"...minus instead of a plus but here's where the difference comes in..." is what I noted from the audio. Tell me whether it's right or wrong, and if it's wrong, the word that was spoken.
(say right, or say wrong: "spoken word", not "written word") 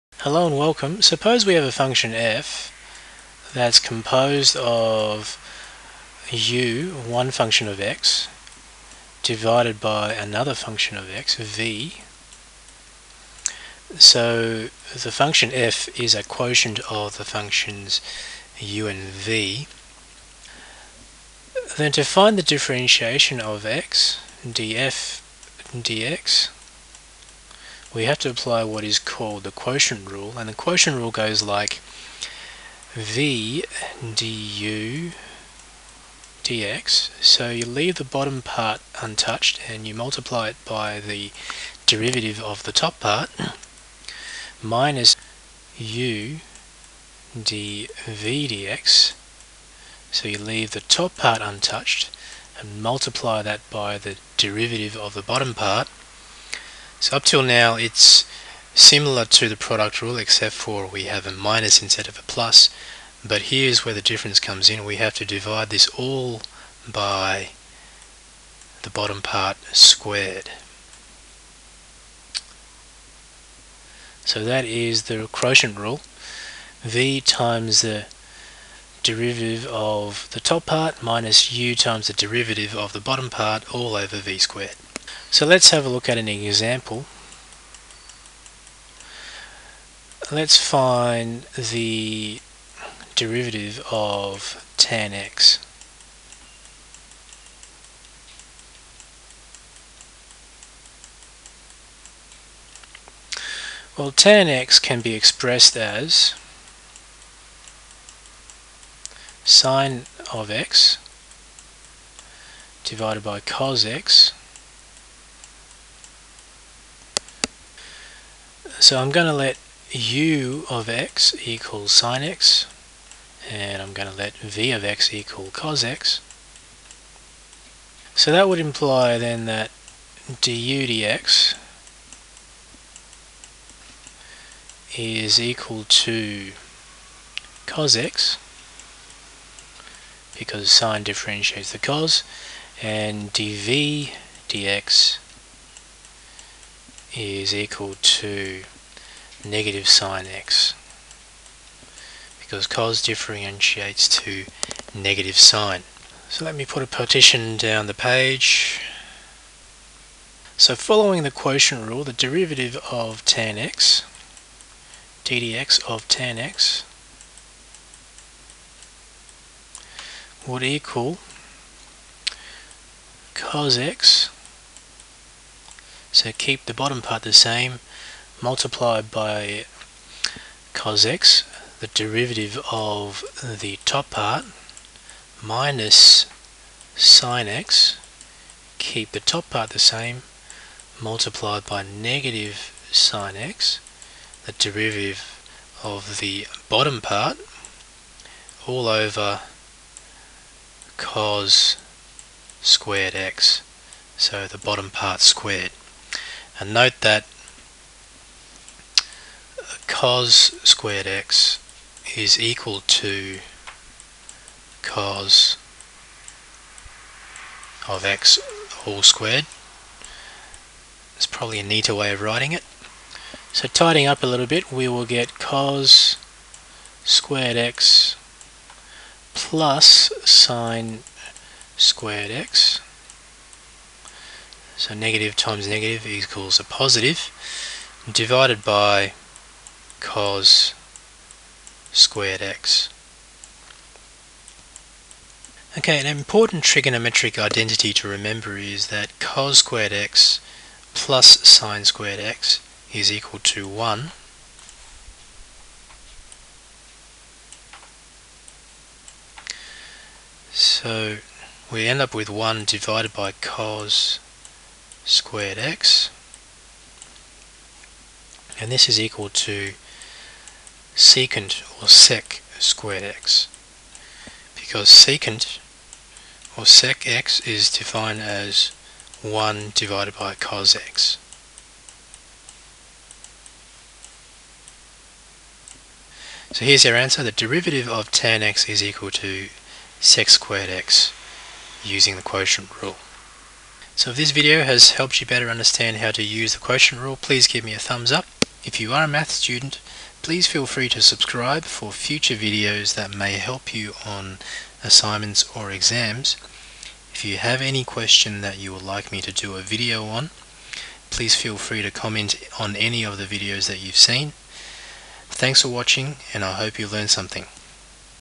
right.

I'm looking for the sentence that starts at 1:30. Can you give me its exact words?
Let's find the derivative of tan x.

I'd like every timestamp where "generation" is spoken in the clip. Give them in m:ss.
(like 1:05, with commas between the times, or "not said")
not said.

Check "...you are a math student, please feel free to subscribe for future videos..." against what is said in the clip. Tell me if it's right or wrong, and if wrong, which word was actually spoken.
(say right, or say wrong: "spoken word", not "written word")
right.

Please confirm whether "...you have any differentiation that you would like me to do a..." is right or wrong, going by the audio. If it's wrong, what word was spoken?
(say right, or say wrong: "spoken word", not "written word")
wrong: "question", not "differentiation".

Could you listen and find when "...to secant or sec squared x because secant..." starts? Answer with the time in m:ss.
4:29.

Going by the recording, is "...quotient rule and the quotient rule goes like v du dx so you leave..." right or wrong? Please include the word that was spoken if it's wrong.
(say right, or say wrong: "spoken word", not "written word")
right.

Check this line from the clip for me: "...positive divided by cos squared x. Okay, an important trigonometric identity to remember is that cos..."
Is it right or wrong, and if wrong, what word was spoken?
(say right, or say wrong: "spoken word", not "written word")
right.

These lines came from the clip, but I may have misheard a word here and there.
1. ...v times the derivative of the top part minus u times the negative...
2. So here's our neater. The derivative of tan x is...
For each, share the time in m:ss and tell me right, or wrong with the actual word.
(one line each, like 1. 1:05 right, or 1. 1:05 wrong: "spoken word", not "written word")
1. 1:16 wrong: "derivative", not "negative"
2. 4:46 wrong: "answer", not "neater".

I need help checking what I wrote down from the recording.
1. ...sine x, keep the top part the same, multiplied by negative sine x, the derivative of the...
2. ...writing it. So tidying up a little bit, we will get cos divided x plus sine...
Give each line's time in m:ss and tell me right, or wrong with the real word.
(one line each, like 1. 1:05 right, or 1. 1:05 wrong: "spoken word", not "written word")
1. 3:06 right
2. 3:42 wrong: "squared", not "divided".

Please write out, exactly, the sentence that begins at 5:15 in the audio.
Thanks for watching and I hope you learned something.